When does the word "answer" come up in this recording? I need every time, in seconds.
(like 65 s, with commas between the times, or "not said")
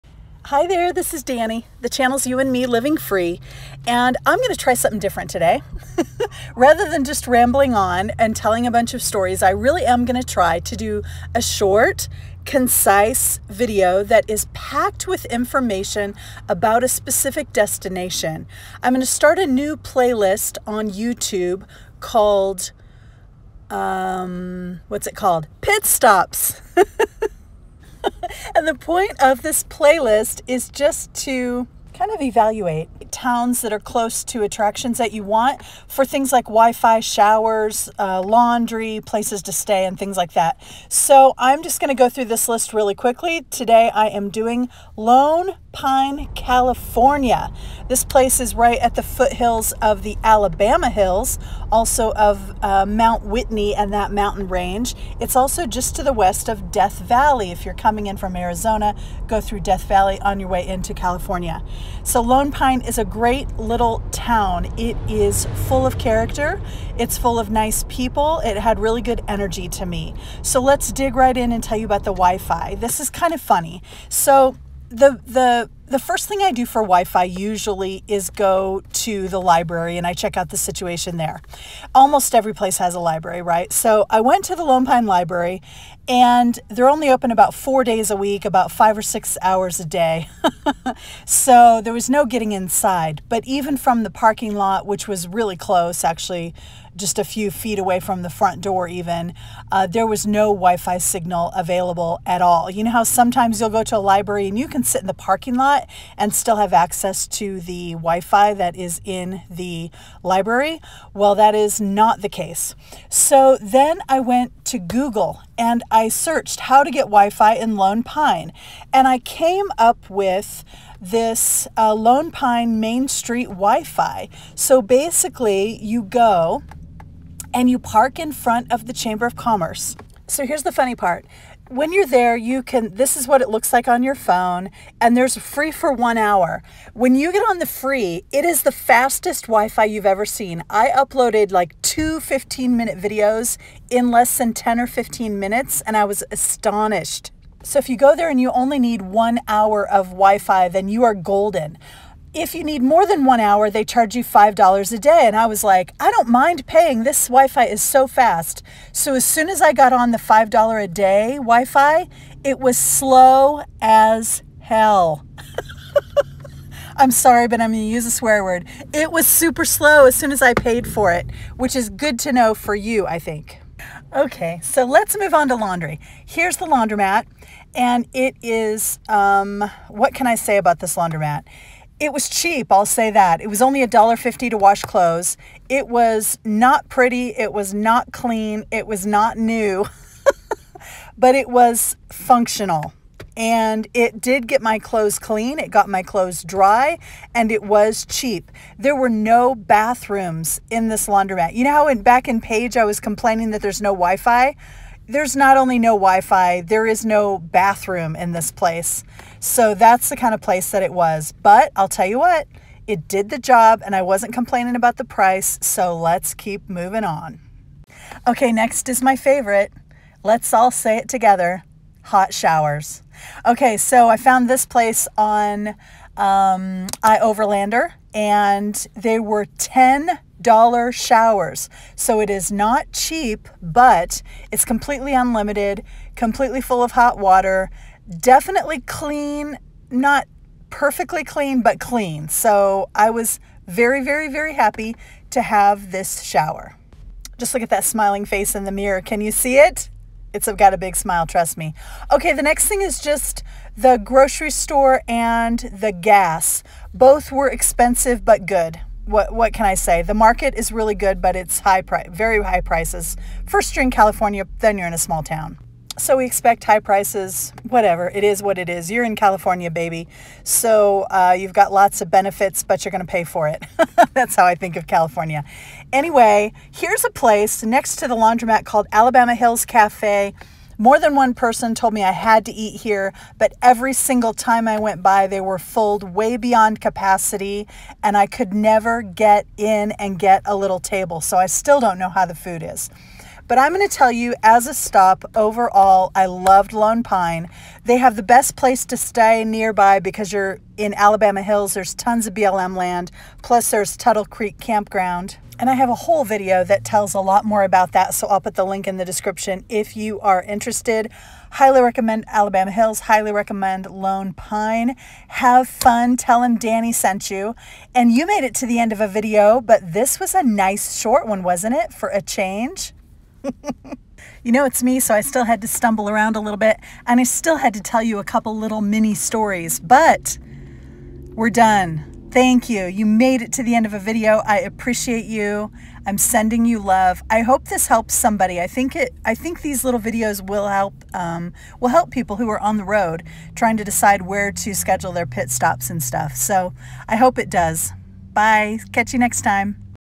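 not said.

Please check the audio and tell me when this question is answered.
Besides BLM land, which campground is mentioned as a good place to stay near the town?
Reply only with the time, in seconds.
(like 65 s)
303 s.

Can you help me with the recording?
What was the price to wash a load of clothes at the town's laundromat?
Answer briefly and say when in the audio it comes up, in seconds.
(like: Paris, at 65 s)
$1.50, at 183 s.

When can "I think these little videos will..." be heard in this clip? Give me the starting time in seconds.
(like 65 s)
339 s.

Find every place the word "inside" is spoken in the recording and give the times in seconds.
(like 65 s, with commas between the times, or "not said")
92 s.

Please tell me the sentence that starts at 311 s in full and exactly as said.
Highly recommend Alabama Hills, highly recommend Lone Pine.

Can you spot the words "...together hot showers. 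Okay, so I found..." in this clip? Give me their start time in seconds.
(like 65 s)
221 s.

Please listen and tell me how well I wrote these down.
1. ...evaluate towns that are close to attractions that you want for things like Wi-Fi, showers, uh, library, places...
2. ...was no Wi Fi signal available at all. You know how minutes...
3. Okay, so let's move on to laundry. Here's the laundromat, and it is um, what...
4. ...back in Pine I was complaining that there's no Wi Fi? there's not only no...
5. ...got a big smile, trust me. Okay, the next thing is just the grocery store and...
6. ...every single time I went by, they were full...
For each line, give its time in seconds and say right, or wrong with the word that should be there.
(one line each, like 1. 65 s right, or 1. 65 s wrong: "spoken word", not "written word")
1. 32 s wrong: "laundry", not "library"
2. 100 s wrong: "sometimes", not "minutes"
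3. 174 s right
4. 202 s wrong: "Page", not "Pine"
5. 250 s right
6. 283 s right.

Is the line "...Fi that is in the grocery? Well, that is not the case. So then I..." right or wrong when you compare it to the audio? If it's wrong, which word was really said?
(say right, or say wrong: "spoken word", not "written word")
wrong: "library", not "grocery".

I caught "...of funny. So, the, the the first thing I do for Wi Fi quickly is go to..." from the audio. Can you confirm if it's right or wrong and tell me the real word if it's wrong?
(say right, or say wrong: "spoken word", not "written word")
wrong: "usually", not "quickly".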